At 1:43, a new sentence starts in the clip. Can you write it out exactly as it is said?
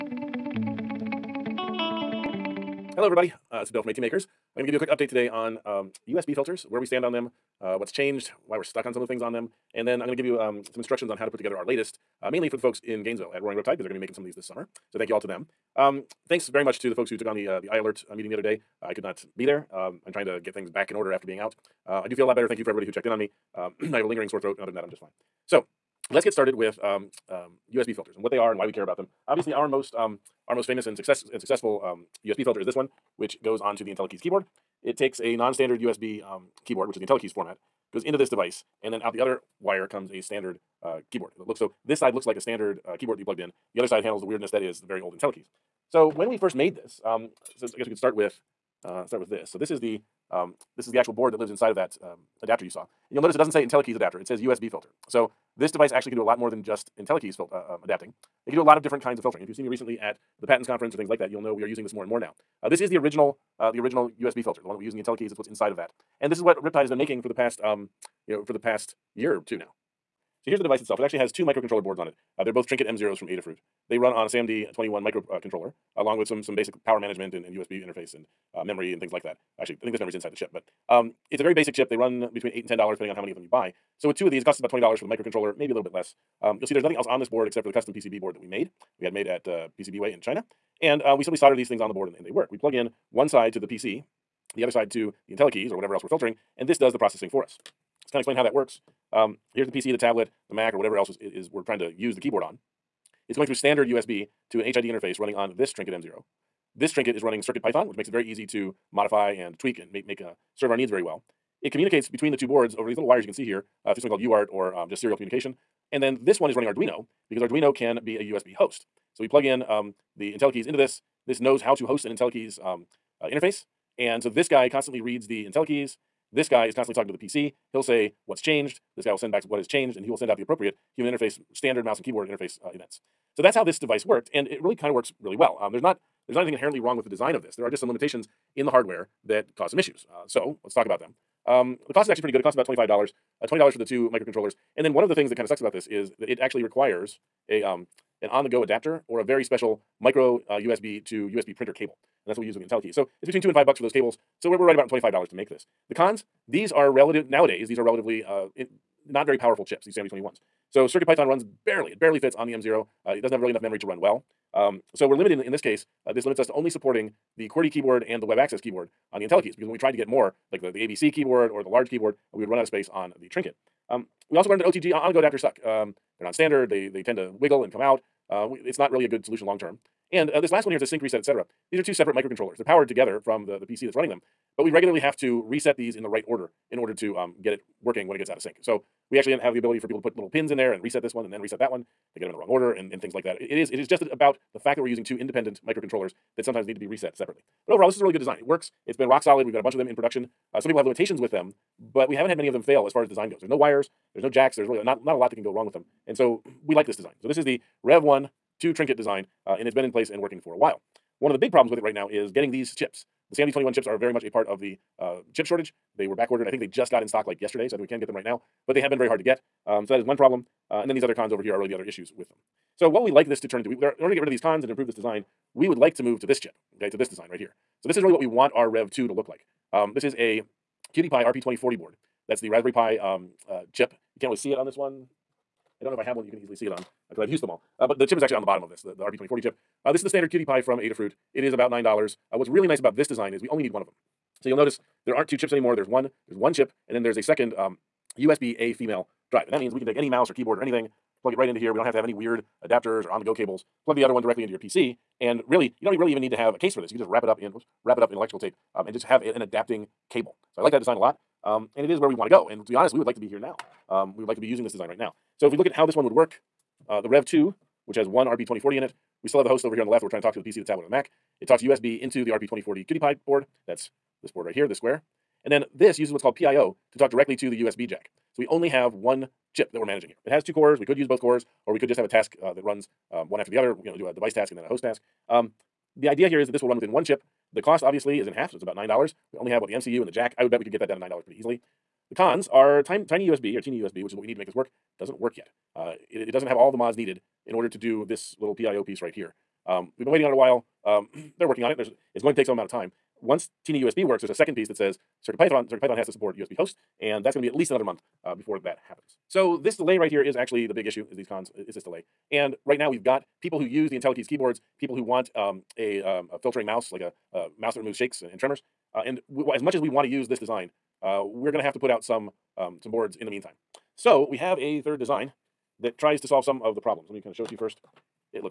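It's going through standard USB to an HID interface running on this Trinket M0.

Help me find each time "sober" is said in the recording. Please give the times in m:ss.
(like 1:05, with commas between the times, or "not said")
not said.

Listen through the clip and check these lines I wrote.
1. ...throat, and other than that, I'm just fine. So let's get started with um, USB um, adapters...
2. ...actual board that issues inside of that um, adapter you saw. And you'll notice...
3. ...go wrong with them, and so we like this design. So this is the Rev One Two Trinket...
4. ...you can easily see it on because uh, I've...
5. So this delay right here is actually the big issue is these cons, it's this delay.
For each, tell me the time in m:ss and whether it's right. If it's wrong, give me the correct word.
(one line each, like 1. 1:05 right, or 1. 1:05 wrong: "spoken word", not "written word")
1. 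0:24 wrong: "filters", not "adapters"
2. 0:50 wrong: "lives", not "issues"
3. 3:25 right
4. 3:56 right
5. 5:09 right.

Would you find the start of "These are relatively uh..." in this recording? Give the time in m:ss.
2:37.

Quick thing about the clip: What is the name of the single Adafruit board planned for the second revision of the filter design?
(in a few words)
QT Py RP2040.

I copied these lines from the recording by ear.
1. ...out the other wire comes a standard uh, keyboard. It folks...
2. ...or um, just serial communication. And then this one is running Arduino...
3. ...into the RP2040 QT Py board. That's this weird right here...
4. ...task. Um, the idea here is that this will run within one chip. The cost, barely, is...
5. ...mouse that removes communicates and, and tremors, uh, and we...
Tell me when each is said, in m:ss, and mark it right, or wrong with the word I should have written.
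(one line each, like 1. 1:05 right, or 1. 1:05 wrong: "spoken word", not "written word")
1. 0:39 wrong: "looks", not "folks"
2. 1:54 right
3. 4:31 wrong: "board", not "weird"
4. 4:44 wrong: "obviously", not "barely"
5. 5:17 wrong: "shakes", not "communicates".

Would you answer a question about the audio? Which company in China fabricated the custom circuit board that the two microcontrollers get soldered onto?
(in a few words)
PCBWay.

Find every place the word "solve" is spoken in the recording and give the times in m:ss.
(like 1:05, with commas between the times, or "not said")
5:26.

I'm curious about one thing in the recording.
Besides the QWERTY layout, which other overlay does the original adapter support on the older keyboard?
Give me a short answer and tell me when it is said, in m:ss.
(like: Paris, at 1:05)
web access keyboard, at 2:48.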